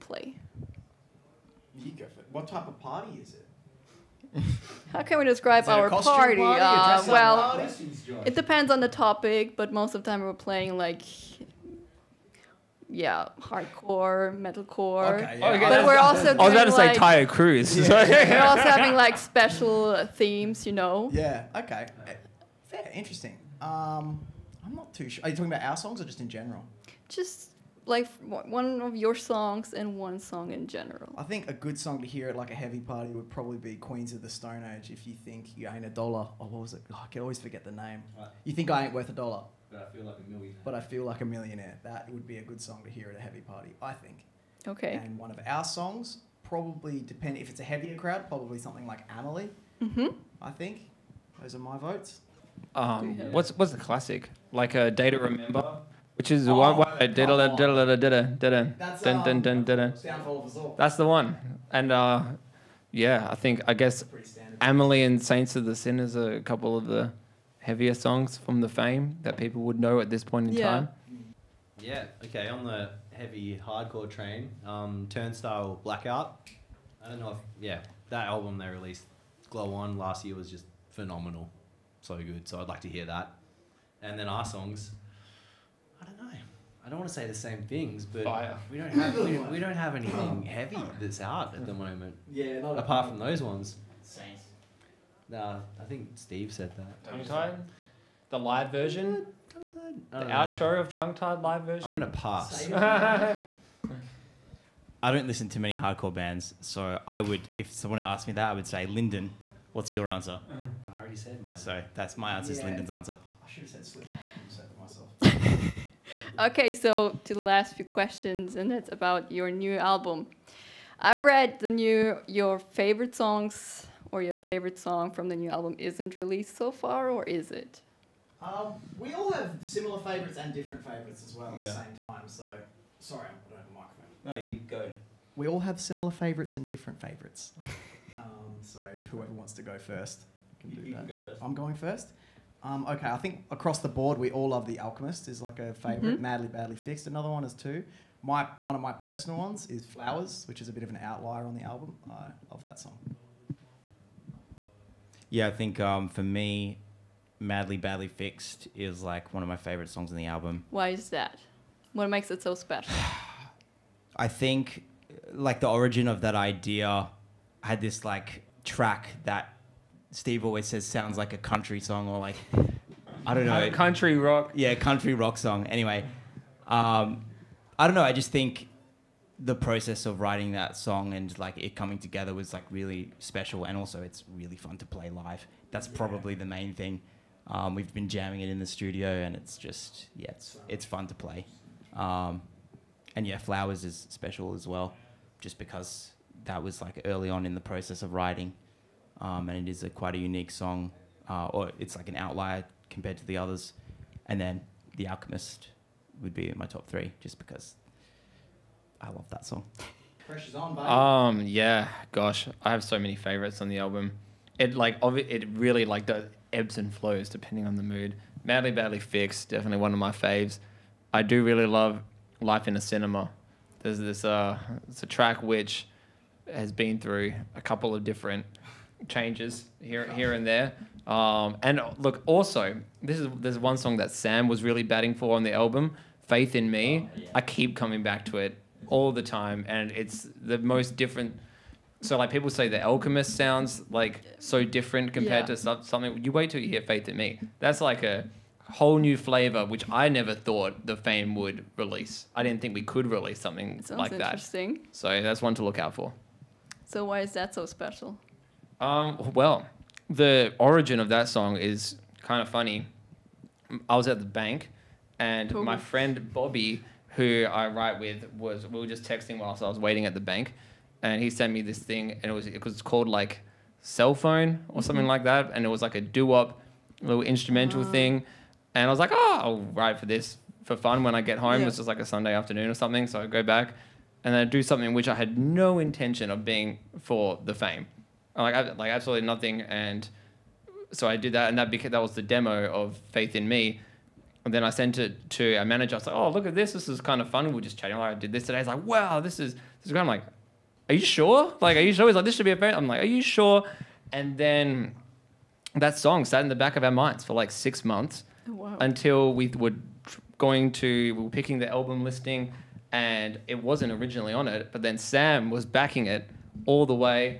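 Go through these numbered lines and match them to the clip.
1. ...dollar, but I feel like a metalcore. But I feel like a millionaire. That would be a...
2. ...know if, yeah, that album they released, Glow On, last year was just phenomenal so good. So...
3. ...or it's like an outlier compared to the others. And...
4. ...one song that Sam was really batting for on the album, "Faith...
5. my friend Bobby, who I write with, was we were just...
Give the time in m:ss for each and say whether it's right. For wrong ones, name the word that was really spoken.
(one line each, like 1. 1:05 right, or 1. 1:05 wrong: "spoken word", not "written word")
1. 0:39 wrong: "millionaire", not "metalcore"
2. 1:17 right
3. 3:21 right
4. 3:53 right
5. 4:25 right.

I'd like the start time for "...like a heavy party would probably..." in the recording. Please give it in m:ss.
0:32.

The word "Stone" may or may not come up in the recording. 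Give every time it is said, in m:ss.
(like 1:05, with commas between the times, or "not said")
0:34.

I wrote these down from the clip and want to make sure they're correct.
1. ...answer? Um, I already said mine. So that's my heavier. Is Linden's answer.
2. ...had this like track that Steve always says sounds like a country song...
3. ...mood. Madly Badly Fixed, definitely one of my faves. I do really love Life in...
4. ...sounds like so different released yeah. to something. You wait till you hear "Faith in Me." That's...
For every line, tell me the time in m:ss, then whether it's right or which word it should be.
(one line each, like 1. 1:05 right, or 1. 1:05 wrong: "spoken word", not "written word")
1. 1:50 wrong: "answer", not "heavier"
2. 2:47 right
3. 3:37 right
4. 4:03 wrong: "compared", not "released".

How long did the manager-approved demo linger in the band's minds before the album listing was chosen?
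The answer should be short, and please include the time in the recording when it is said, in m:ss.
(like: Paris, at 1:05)
6 months, at 5:07.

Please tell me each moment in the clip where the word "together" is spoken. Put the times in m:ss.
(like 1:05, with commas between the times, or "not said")
3:01.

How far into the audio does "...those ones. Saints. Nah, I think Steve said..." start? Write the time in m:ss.
1:33.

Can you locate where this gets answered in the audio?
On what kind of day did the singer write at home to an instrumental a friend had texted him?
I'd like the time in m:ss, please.
4:42.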